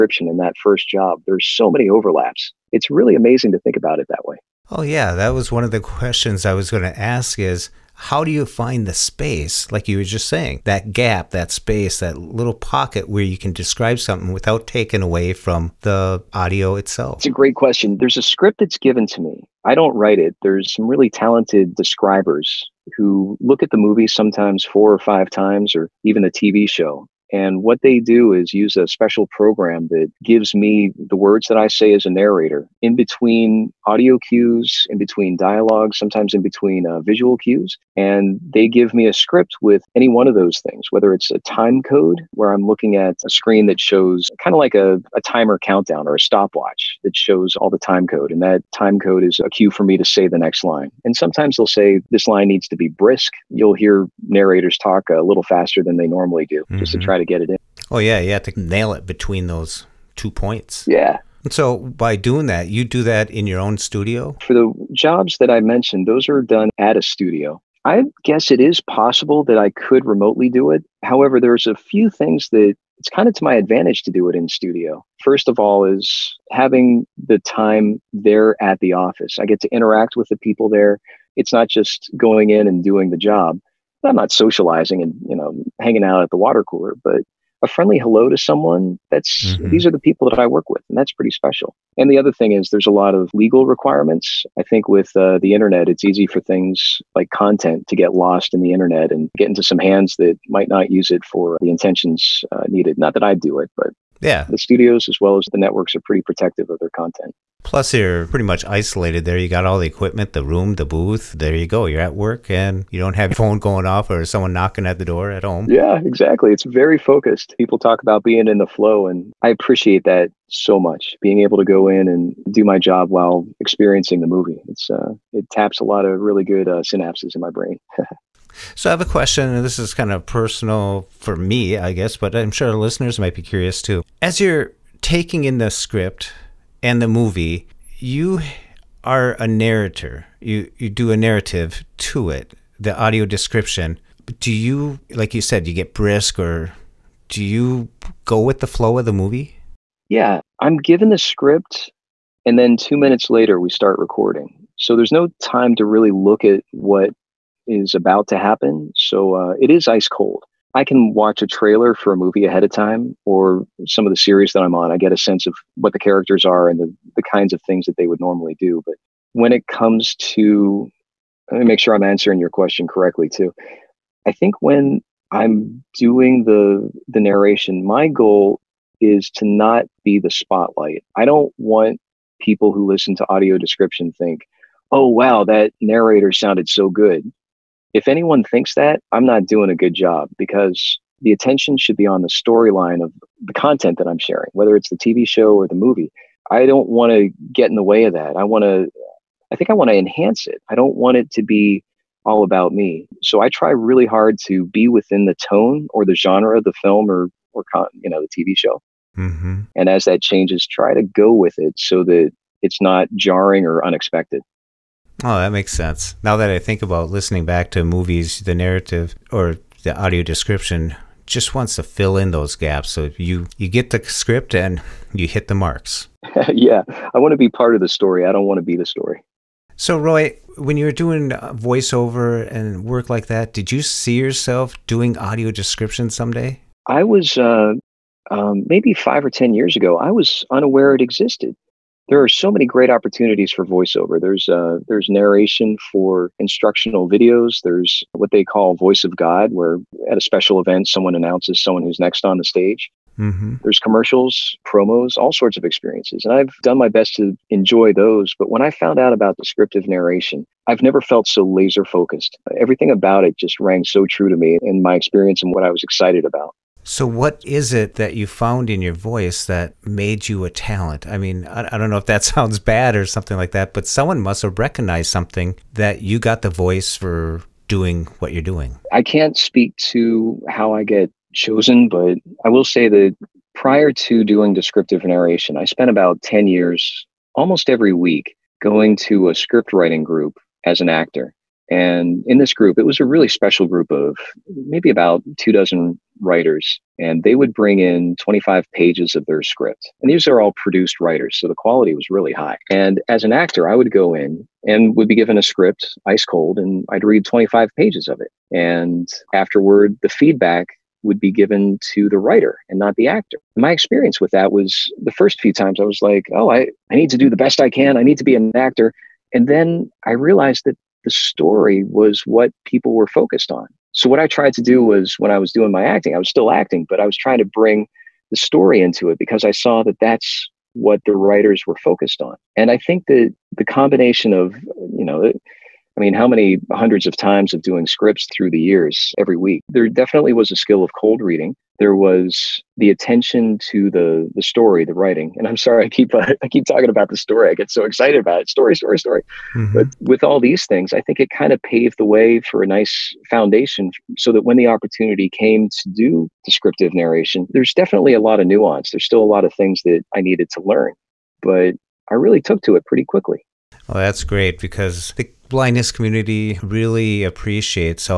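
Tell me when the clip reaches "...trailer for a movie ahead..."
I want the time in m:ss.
2:41.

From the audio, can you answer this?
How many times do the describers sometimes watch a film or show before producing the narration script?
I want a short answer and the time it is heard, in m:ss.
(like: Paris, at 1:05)
4 or 5 times, at 0:24.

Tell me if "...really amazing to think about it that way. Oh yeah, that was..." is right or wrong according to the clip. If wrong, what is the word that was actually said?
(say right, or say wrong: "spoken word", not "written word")
right.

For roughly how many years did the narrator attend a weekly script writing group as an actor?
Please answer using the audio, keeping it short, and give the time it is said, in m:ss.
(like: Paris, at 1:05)
10 years, at 4:46.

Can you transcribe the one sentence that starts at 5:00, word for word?
And these are all produced writers, so the quality was really high.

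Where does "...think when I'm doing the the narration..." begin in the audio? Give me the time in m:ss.
2:54.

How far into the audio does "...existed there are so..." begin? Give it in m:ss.
4:01.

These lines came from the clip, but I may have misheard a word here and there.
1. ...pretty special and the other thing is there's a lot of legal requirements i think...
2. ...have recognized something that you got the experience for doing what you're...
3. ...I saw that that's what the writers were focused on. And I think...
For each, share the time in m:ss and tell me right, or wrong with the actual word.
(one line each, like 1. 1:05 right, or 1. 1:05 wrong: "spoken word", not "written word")
1. 1:31 right
2. 4:34 wrong: "voice", not "experience"
3. 5:29 right.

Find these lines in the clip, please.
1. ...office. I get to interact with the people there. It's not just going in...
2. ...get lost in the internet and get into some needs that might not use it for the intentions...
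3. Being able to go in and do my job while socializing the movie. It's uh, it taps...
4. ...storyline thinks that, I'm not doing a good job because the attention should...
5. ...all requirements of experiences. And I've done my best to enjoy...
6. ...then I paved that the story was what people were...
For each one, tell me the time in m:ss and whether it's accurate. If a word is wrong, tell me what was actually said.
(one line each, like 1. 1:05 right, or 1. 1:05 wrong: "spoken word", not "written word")
1. 1:18 right
2. 1:37 wrong: "hands", not "needs"
3. 2:01 wrong: "experiencing", not "socializing"
4. 3:08 wrong: "anyone", not "storyline"
5. 4:15 wrong: "sorts", not "requirements"
6. 5:19 wrong: "realized", not "paved".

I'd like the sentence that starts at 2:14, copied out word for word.
As you're taking in the script, and the movie, you are a narrator.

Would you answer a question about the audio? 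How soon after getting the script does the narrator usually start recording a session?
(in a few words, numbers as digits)
2 minutes.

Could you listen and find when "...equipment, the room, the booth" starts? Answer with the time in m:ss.
1:49.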